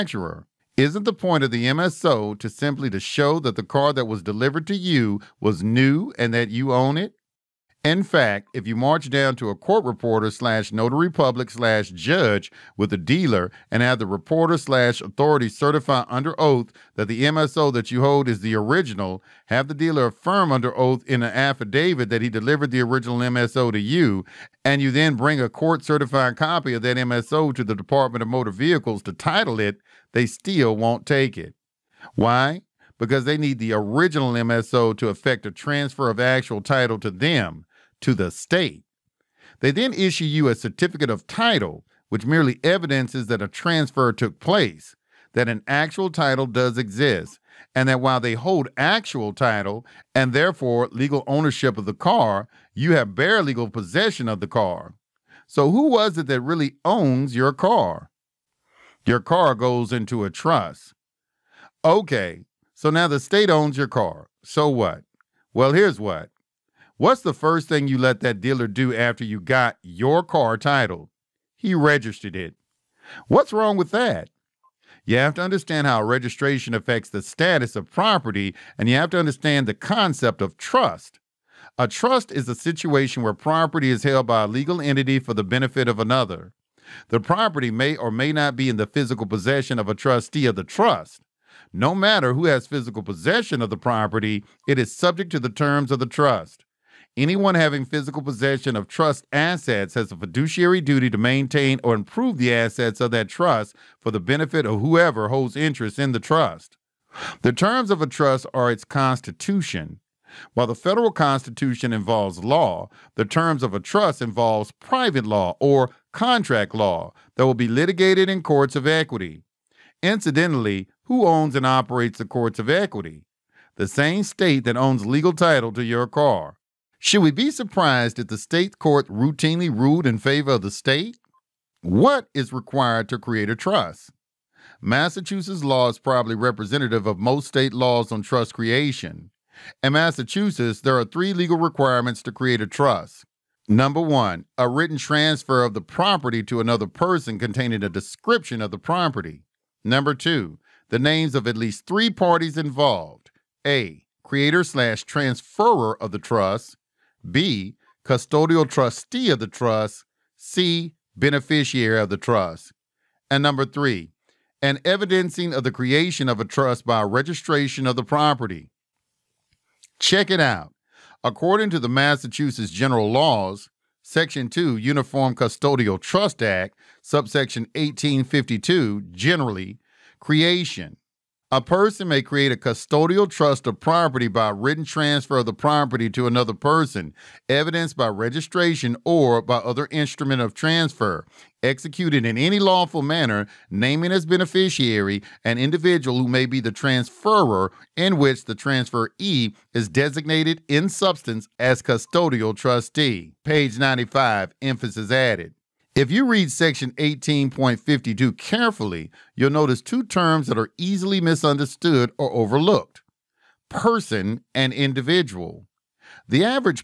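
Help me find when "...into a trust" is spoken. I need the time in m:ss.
0:59.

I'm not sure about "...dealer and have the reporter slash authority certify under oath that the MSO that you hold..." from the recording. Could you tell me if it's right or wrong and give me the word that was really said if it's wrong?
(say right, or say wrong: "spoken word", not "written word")
right.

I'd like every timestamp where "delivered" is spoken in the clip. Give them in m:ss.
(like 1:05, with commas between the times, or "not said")
0:04, 0:22.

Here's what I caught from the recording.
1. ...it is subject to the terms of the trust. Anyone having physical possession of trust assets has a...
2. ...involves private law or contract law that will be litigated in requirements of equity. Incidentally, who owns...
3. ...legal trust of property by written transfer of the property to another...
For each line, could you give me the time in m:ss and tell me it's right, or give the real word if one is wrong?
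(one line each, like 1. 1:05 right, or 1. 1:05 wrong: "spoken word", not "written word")
1. 1:34 right
2. 1:54 wrong: "courts", not "requirements"
3. 3:02 wrong: "custodial", not "legal".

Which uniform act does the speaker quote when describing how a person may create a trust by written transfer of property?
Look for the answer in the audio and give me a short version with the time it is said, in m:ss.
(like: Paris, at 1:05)
Uniform Custodial Trust Act, at 2:54.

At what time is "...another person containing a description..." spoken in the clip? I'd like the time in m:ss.
2:26.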